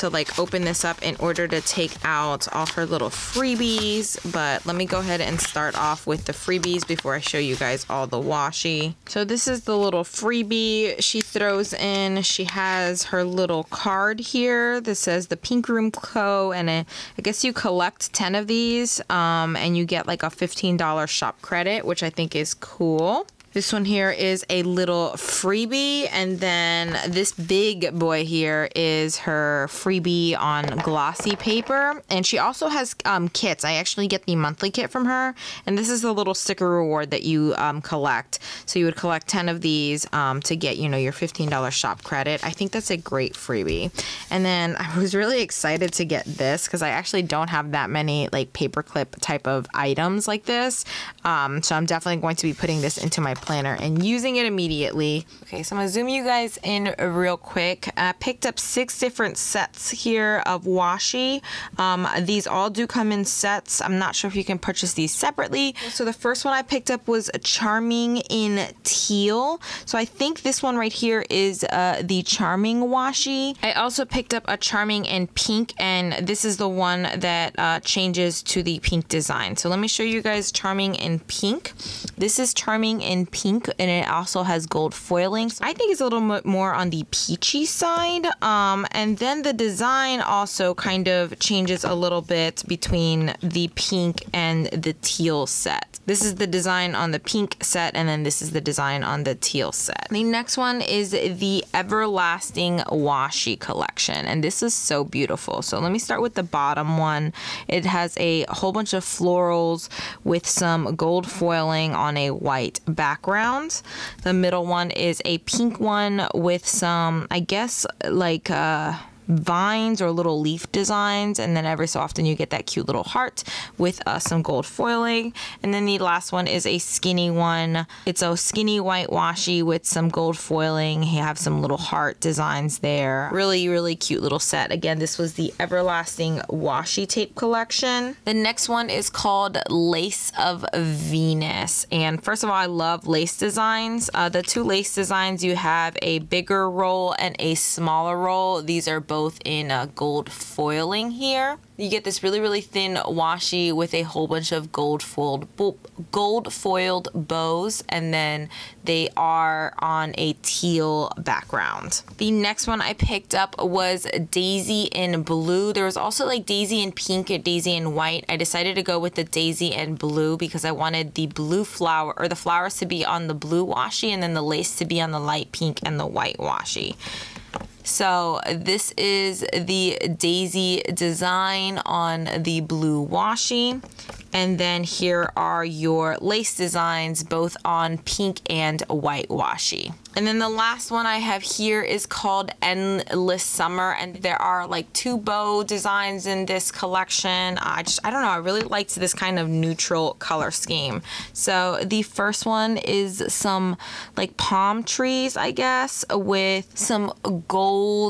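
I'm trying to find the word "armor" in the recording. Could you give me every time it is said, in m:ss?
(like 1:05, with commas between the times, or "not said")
not said.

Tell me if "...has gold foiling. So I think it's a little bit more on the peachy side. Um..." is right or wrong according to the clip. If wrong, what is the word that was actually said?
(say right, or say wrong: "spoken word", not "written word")
right.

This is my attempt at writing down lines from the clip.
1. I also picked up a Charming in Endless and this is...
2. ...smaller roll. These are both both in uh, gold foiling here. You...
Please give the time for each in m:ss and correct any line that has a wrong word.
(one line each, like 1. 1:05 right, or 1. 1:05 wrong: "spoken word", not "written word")
1. 1:13 wrong: "Pink", not "Endless"
2. 2:27 right.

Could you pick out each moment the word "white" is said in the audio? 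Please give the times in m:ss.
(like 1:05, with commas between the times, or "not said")
1:52, 2:08, 2:47, 2:56, 3:08.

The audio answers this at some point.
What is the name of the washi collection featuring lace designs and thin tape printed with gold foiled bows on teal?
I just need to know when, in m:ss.
2:19.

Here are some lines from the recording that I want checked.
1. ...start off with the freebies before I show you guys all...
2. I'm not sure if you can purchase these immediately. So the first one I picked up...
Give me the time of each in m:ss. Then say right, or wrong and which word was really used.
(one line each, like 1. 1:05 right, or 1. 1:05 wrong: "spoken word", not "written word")
1. 0:05 right
2. 1:03 wrong: "separately", not "immediately".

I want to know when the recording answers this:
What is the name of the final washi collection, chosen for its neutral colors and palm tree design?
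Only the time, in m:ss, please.
3:12.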